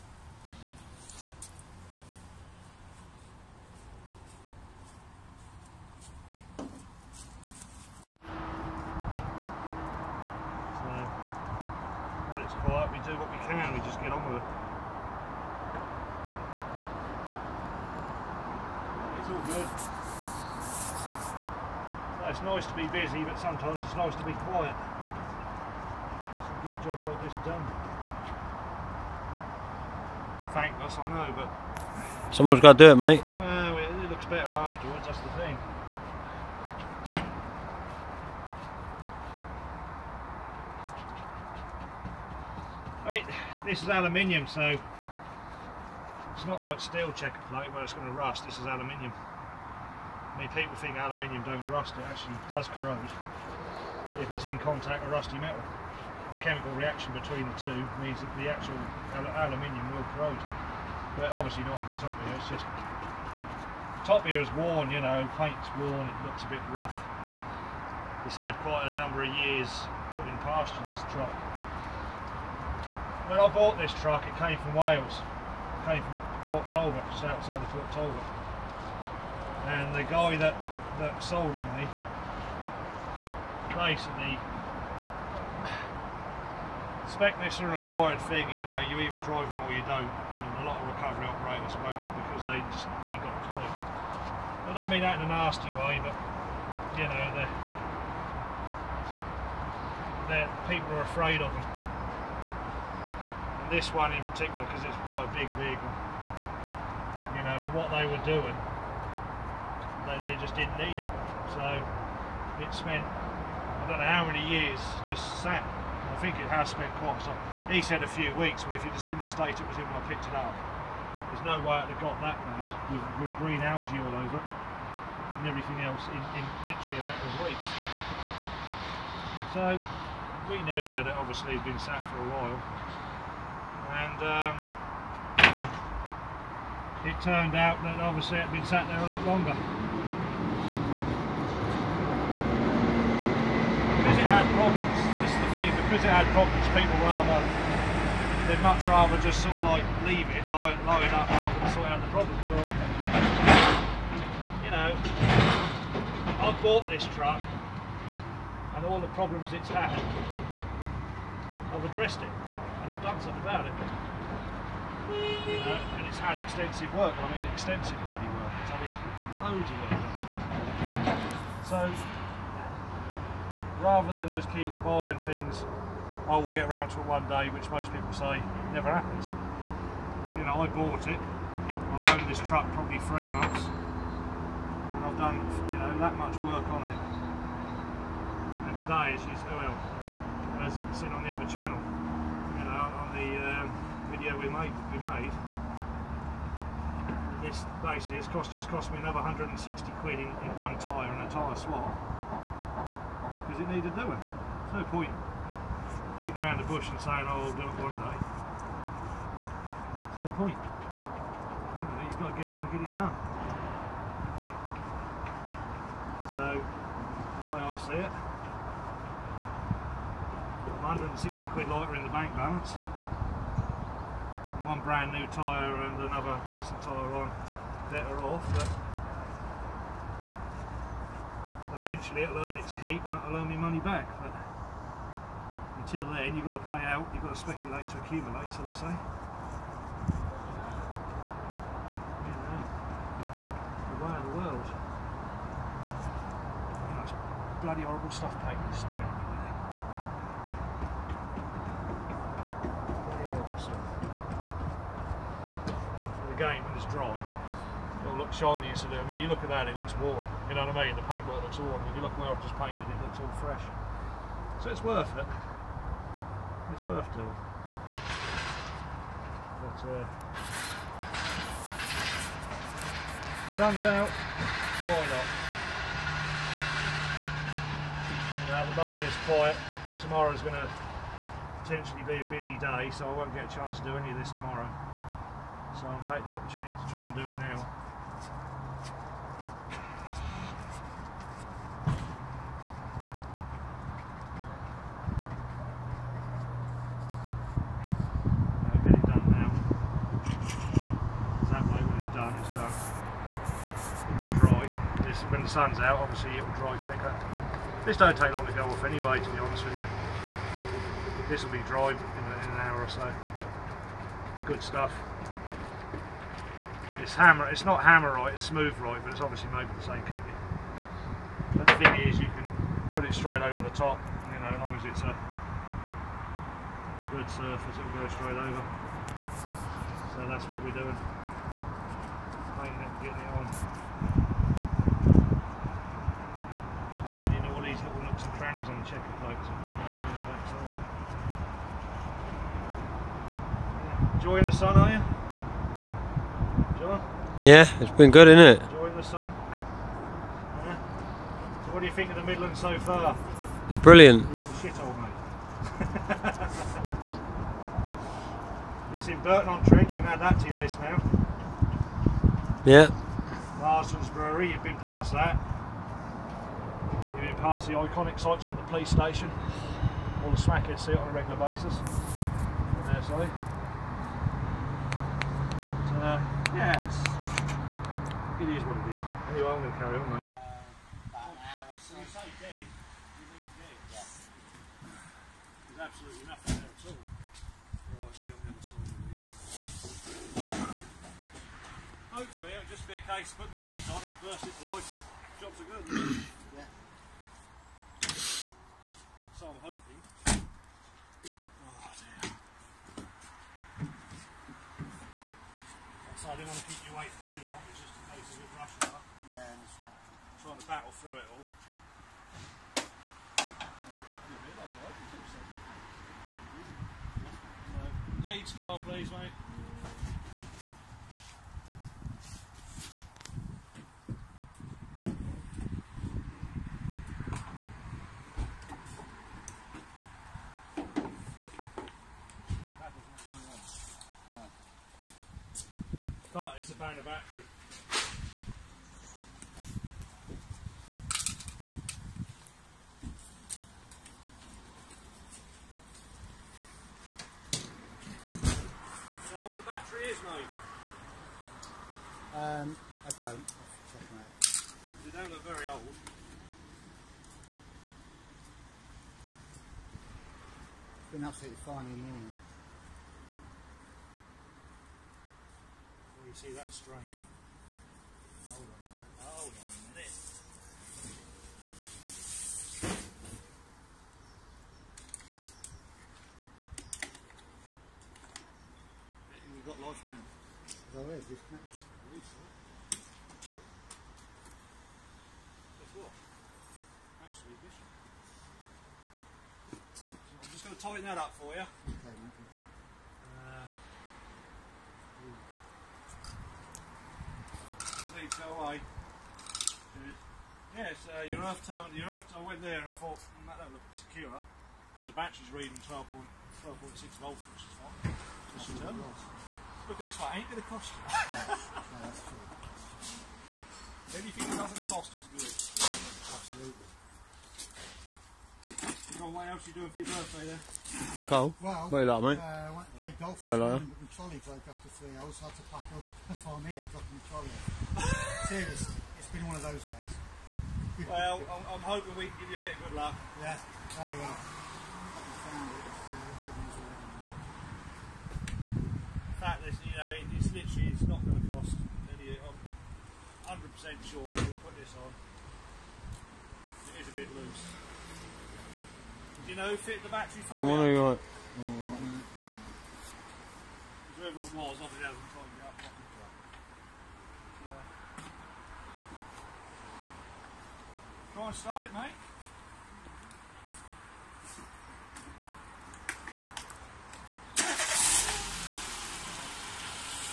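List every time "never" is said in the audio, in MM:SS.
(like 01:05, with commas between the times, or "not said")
02:58.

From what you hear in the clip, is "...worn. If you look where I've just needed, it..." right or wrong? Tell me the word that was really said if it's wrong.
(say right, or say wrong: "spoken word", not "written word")
wrong: "painted", not "needed".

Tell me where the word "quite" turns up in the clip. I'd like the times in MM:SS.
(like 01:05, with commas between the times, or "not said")
01:08, 01:45, 01:56.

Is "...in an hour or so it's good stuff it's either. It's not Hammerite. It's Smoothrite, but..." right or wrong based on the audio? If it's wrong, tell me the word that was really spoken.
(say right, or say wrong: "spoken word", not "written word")
wrong: "hammer", not "either".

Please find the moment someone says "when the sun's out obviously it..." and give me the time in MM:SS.
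05:05.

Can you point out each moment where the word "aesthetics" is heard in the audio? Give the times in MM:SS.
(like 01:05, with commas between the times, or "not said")
not said.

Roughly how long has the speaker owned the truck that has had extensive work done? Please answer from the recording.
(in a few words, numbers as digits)
3 months.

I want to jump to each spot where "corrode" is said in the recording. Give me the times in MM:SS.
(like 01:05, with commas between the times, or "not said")
00:52, 01:00.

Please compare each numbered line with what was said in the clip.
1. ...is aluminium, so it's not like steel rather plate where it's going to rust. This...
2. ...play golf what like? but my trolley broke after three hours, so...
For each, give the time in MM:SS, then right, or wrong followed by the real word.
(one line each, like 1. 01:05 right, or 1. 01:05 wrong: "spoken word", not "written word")
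1. 00:43 wrong: "checker", not "rather"
2. 08:42 right.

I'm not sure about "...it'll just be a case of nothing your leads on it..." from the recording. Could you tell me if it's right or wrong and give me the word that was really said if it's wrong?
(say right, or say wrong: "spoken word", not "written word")
wrong: "putting", not "nothing".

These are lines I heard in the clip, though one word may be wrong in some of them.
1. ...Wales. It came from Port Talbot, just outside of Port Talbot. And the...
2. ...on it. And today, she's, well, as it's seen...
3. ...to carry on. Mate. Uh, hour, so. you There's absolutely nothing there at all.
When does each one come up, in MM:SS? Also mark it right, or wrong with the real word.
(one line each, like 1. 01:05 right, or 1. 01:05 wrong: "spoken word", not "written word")
1. 01:14 right
2. 03:06 right
3. 06:19 right.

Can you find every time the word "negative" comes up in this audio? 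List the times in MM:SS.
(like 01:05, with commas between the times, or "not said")
not said.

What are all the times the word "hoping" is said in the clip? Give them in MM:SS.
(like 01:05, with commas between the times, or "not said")
06:39, 08:51.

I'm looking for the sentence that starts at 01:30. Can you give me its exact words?
And a lot of recovery operators won't because they just ain't got a clue.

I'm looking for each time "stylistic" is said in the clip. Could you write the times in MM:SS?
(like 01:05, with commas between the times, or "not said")
not said.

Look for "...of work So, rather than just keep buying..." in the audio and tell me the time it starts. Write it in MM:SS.
02:49.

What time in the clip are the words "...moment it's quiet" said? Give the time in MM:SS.
04:38.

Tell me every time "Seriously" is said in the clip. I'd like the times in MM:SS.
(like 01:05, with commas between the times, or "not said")
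08:48.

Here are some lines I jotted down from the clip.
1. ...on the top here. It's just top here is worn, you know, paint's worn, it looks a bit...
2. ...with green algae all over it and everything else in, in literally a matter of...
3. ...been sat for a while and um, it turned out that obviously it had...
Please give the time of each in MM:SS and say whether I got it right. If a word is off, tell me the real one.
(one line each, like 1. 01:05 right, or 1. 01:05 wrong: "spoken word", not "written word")
1. 01:01 right
2. 02:03 right
3. 02:11 right.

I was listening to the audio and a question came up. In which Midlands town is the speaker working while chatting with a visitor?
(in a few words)
Burton on Trent.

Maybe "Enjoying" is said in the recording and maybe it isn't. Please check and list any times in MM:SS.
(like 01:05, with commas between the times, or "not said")
05:44, 05:48.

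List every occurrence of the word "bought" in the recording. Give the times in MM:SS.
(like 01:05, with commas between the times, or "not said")
01:13, 02:36, 03:00.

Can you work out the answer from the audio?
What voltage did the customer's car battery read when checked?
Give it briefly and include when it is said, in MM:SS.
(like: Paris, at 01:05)
12.6 volts, at 08:25.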